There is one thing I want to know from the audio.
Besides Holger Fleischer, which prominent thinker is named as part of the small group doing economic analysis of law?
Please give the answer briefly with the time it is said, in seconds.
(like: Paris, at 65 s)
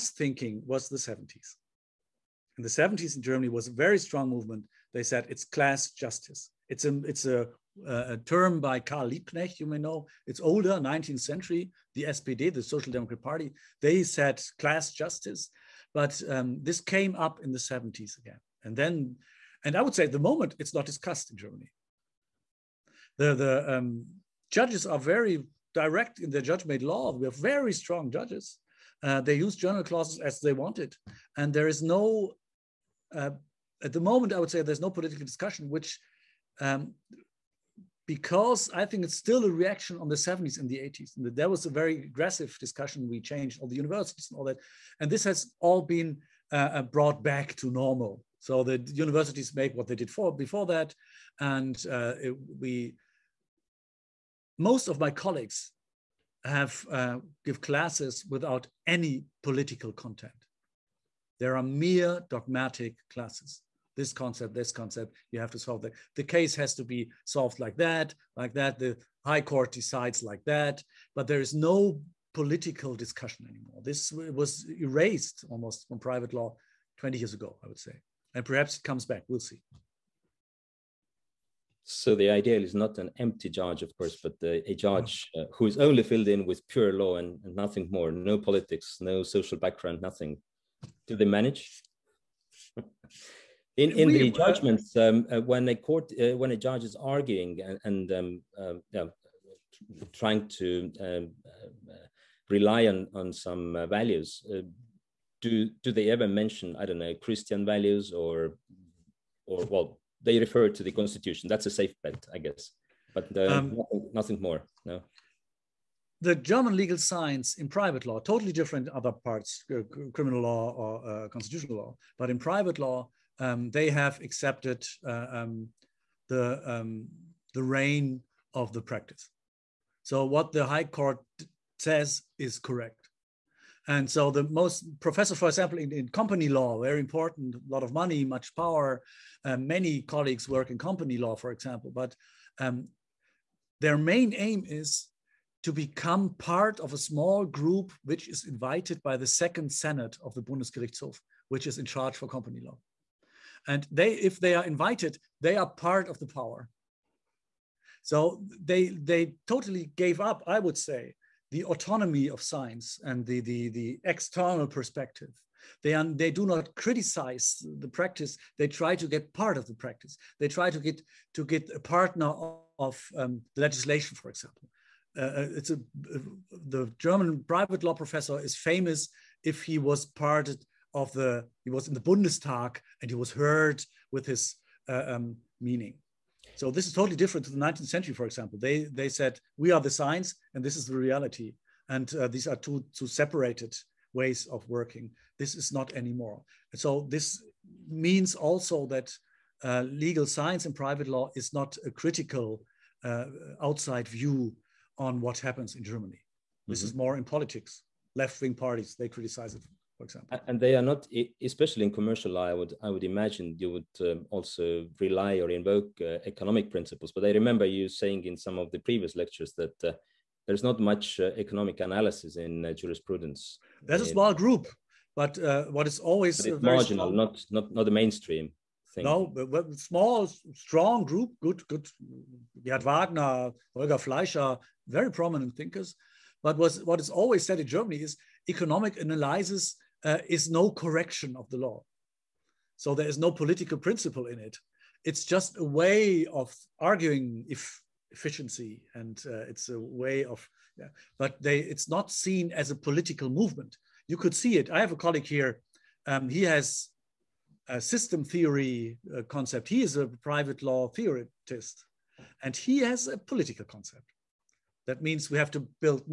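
Gerhard Wagner, at 232 s.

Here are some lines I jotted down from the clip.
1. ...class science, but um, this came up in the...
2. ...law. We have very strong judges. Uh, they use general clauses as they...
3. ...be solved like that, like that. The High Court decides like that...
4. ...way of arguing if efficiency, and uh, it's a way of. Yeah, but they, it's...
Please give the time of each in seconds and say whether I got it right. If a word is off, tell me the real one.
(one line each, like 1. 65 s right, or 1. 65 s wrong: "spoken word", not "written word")
1. 14 s wrong: "justice", not "science"
2. 26 s right
3. 66 s right
4. 245 s right.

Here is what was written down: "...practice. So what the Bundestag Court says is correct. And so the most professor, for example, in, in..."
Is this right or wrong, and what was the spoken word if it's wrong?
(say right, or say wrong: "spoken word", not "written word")
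wrong: "High", not "Bundestag".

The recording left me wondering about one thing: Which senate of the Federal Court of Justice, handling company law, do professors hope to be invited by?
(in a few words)
Second Senate.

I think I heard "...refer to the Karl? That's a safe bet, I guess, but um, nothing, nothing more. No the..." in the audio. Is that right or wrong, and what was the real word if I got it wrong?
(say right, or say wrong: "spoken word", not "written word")
wrong: "Constitution", not "Karl".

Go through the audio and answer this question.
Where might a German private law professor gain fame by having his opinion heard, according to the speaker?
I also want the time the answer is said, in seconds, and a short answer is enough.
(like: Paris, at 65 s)
Bundestag, at 181 s.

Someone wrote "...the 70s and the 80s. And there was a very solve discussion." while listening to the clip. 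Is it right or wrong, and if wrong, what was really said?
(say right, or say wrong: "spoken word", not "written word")
wrong: "aggressive", not "solve".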